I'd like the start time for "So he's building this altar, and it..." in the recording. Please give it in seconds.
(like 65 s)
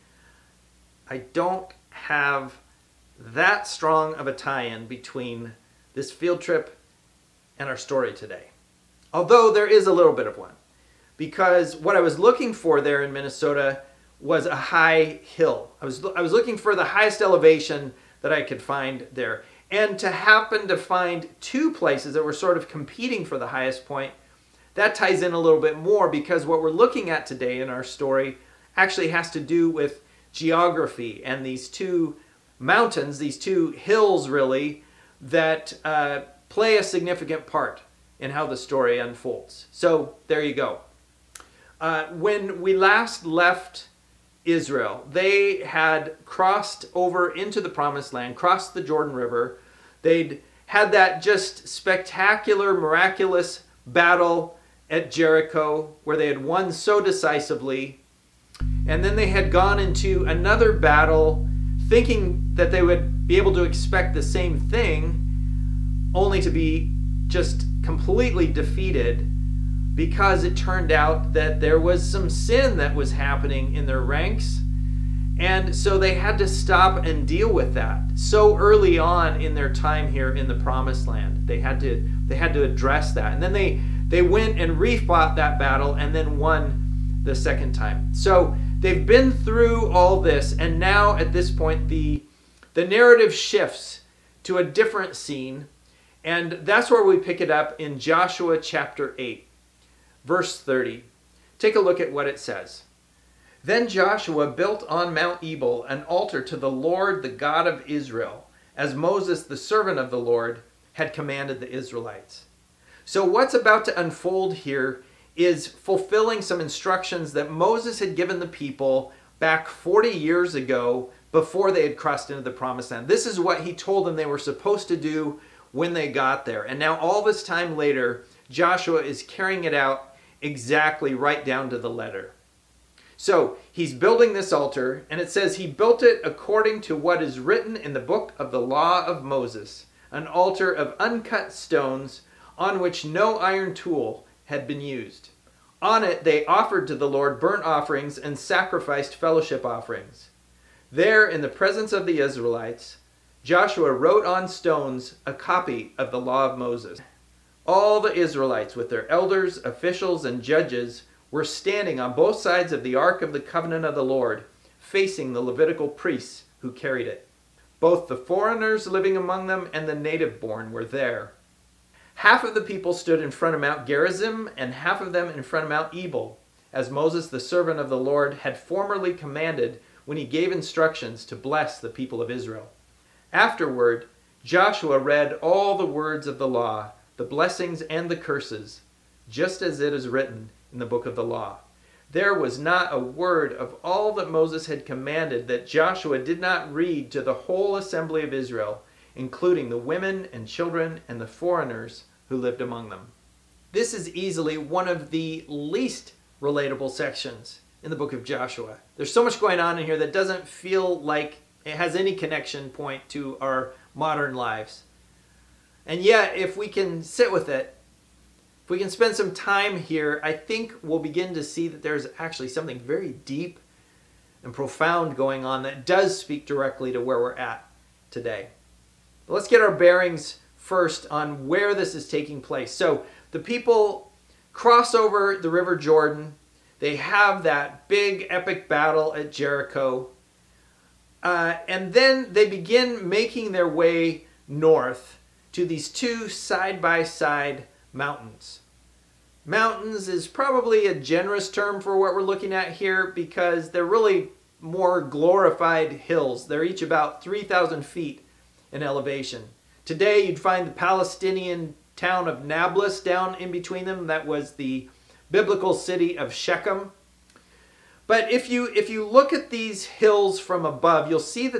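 133 s.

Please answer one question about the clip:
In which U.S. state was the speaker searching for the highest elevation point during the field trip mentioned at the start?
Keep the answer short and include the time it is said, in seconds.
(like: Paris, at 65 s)
Minnesota, at 13 s.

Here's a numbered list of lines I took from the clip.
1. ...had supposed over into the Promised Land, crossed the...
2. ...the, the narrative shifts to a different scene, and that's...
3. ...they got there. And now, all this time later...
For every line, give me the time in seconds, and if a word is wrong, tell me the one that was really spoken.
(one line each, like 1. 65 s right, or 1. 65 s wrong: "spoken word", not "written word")
1. 45 s wrong: "crossed", not "supposed"
2. 91 s right
3. 125 s right.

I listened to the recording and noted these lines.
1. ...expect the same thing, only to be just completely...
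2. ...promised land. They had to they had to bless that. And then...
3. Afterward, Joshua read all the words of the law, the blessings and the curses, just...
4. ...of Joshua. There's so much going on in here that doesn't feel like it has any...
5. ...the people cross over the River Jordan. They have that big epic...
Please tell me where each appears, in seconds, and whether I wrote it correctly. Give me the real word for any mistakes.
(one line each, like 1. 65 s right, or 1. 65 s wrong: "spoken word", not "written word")
1. 63 s right
2. 80 s wrong: "address", not "bless"
3. 183 s right
4. 208 s right
5. 233 s right.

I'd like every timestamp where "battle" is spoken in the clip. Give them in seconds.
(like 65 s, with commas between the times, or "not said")
53 s, 60 s, 85 s, 238 s.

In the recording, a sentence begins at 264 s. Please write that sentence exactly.
That was the biblical city of Shechem.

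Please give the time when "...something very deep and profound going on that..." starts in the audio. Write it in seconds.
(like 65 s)
222 s.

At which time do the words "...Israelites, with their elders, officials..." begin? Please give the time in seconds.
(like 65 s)
158 s.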